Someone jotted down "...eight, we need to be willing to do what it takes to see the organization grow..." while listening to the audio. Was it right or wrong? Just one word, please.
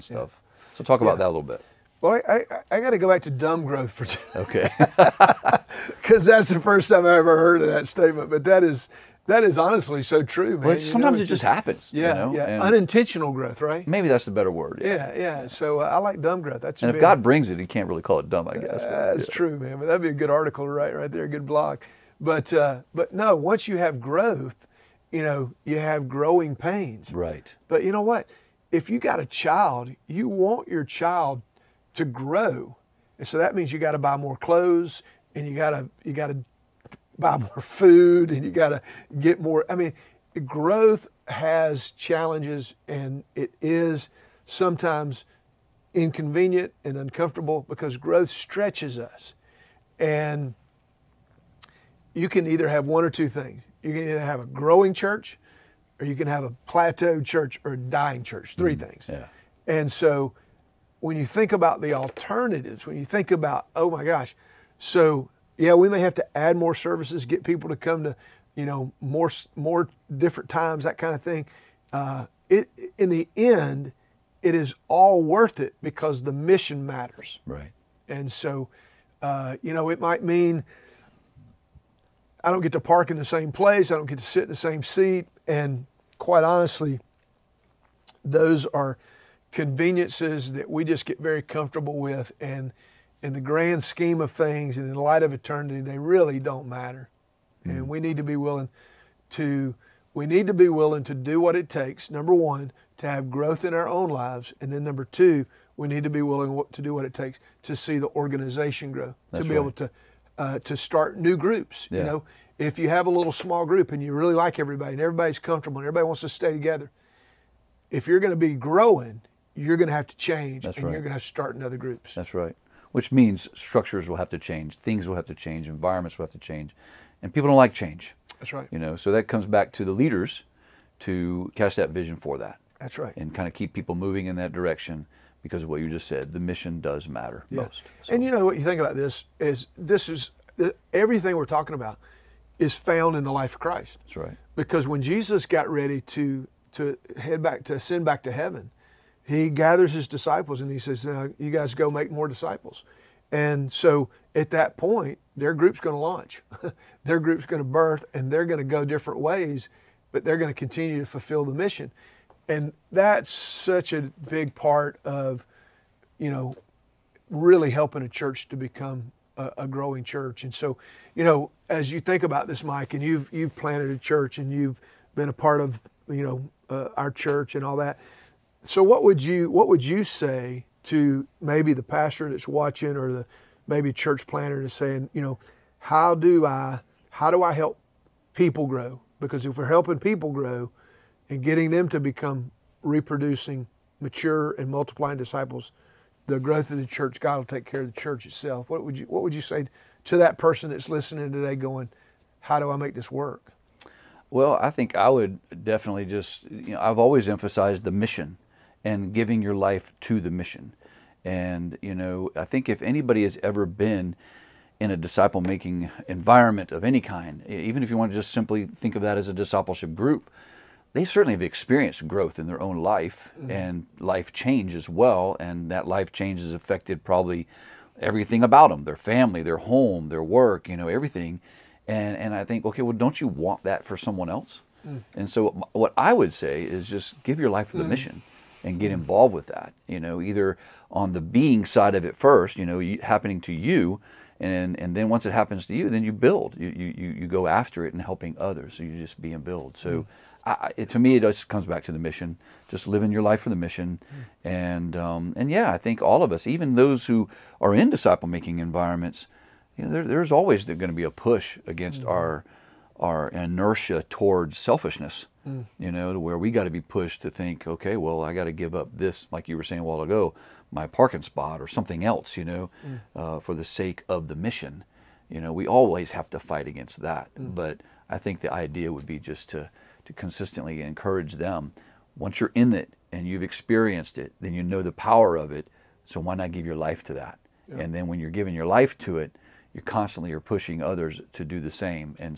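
wrong.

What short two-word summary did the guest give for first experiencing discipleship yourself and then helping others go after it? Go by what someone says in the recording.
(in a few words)
Be and build.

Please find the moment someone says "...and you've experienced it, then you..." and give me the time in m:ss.
4:43.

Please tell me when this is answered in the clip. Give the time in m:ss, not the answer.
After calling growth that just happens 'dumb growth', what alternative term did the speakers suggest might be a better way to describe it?
0:12.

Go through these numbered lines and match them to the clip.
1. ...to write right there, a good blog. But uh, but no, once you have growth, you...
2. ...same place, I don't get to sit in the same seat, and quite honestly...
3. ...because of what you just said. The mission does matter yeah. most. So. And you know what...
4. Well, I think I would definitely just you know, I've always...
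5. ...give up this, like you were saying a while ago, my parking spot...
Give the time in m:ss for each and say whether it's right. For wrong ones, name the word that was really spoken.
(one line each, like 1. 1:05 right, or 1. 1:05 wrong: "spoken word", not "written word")
1. 0:20 right
2. 1:23 right
3. 2:15 right
4. 3:24 right
5. 4:28 right.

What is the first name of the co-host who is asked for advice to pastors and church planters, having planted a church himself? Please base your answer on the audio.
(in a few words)
Mike.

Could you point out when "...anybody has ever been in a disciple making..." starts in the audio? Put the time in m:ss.
3:32.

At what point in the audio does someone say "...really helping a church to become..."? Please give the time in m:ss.
2:47.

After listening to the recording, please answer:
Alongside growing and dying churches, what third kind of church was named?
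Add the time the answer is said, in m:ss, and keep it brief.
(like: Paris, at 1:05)
Plateaued church, at 0:56.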